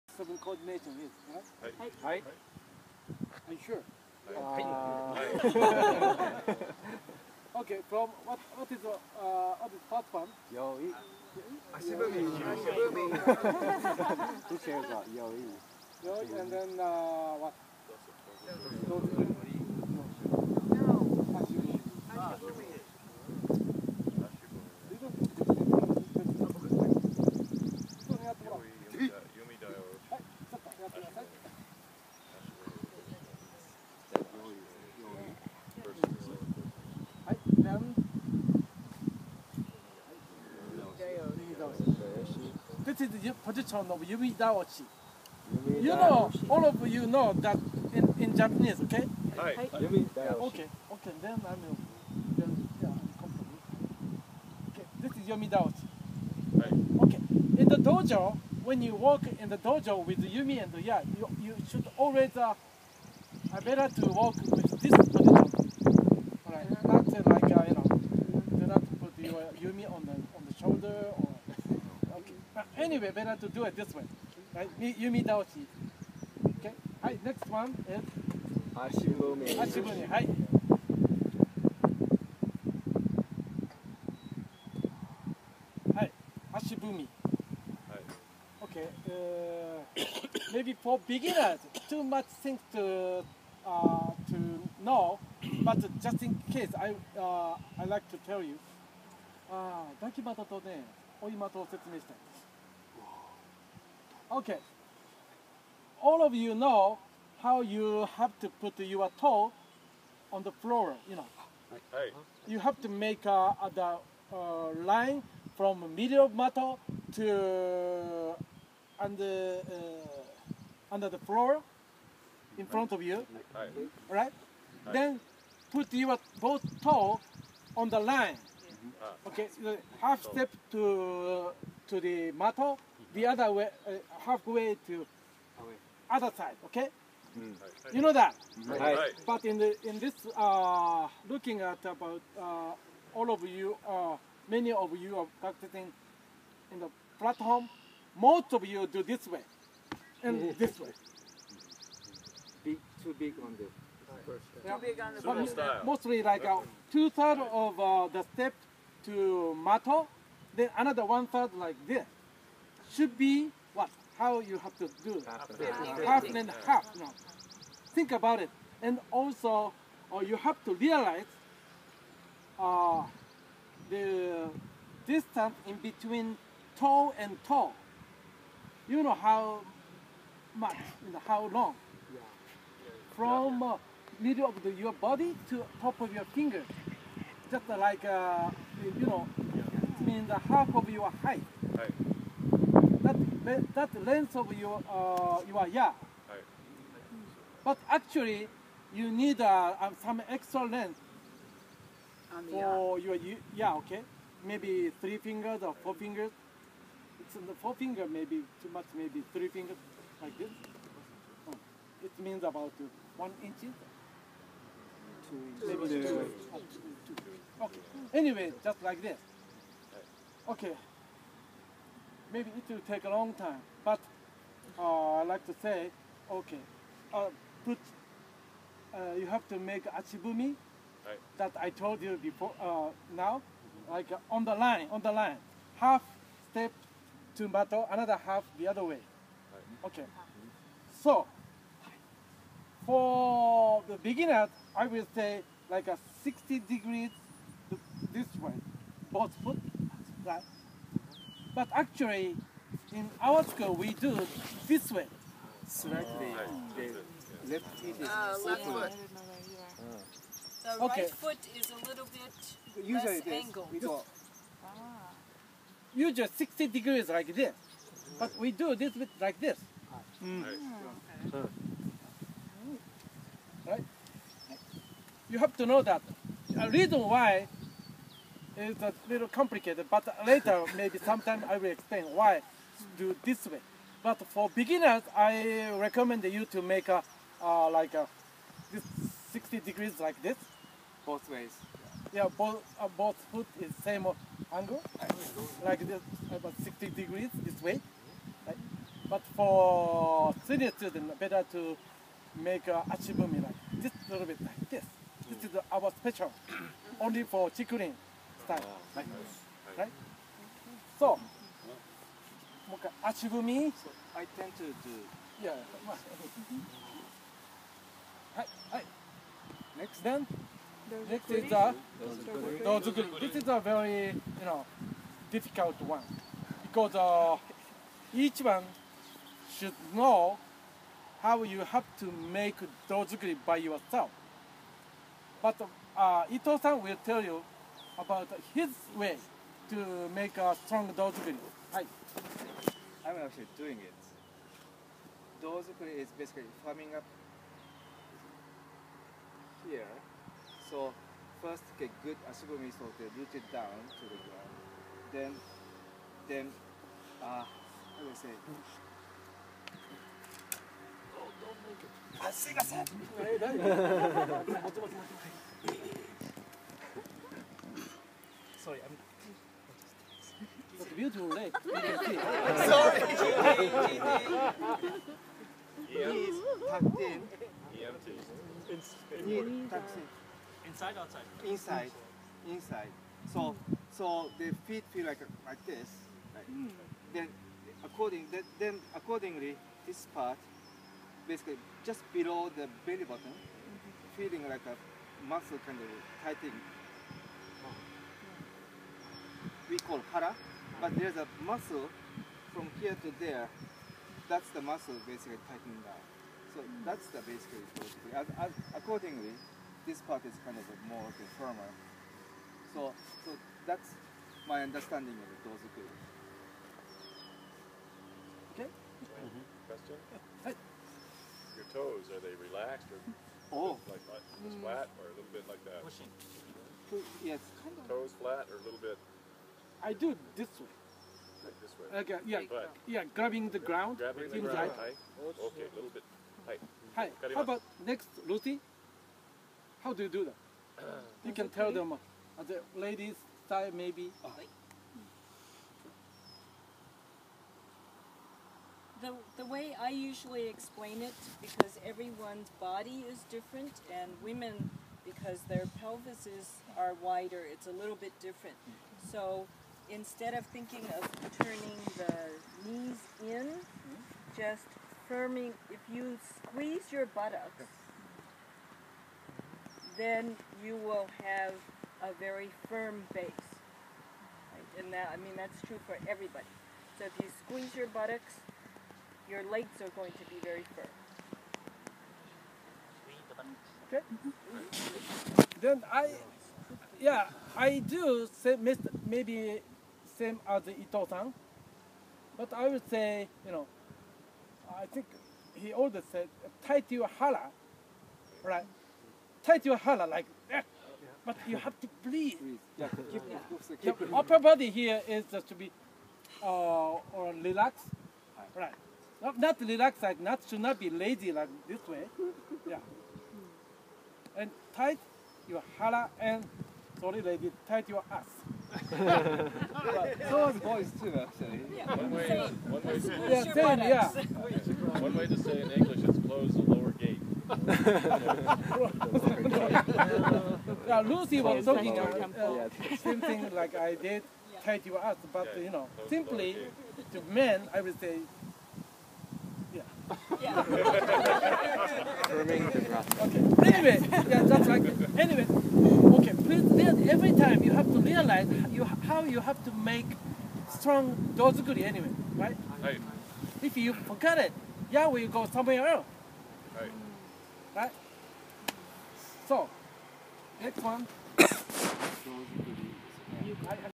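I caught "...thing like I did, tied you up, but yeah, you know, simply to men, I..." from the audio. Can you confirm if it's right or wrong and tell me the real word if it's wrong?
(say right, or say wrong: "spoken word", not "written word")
right.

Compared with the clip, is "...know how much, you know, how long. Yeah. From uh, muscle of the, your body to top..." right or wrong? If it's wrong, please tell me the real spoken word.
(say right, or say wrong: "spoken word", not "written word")
wrong: "middle", not "muscle".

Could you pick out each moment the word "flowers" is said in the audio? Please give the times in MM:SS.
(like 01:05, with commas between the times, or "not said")
not said.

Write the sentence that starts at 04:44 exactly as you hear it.
But for beginners, I recommend you to make a uh, like a, this 60 degrees like this.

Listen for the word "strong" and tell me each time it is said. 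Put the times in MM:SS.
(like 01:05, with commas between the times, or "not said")
05:40, 09:10.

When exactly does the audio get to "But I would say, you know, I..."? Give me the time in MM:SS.
08:12.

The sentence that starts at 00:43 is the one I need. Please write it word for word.
is the position of Yumi daoshi.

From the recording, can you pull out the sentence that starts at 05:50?
So first get good ashibumi so they root it down to the ground.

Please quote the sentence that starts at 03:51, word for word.
that I told you before, uh, now, mm -hmm.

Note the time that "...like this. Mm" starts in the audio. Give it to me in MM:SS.
04:29.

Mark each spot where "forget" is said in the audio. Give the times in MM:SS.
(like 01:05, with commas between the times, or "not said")
09:13.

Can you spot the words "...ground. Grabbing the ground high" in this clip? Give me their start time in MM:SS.
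07:13.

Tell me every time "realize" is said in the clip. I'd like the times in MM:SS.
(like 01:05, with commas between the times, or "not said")
02:50, 09:07.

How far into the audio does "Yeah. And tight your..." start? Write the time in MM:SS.
08:32.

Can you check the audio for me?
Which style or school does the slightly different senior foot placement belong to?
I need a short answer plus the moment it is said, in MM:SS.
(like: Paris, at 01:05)
Chikurin, at 05:07.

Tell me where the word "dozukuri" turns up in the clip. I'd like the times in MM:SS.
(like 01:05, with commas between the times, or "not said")
05:22, 05:32, 05:40, 05:45, 06:55, 09:11.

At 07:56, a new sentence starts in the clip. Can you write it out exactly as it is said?
So if you squeeze your buttocks, your legs are going to be very firm.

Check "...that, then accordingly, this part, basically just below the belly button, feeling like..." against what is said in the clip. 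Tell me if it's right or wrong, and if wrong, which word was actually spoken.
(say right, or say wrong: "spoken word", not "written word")
right.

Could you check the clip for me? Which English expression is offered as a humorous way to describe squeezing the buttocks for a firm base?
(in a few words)
close the lower gate.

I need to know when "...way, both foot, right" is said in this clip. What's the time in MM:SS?
04:08.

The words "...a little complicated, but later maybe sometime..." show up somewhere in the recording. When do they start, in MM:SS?
04:38.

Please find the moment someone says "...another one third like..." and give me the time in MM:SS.
02:40.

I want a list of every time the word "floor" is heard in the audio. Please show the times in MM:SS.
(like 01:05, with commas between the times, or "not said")
01:50, 02:01.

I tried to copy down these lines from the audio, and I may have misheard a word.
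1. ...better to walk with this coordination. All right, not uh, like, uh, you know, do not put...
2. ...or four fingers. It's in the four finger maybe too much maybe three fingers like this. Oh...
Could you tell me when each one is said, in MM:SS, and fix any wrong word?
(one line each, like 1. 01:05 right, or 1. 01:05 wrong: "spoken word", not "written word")
1. 01:03 wrong: "position", not "coordination"
2. 03:25 right.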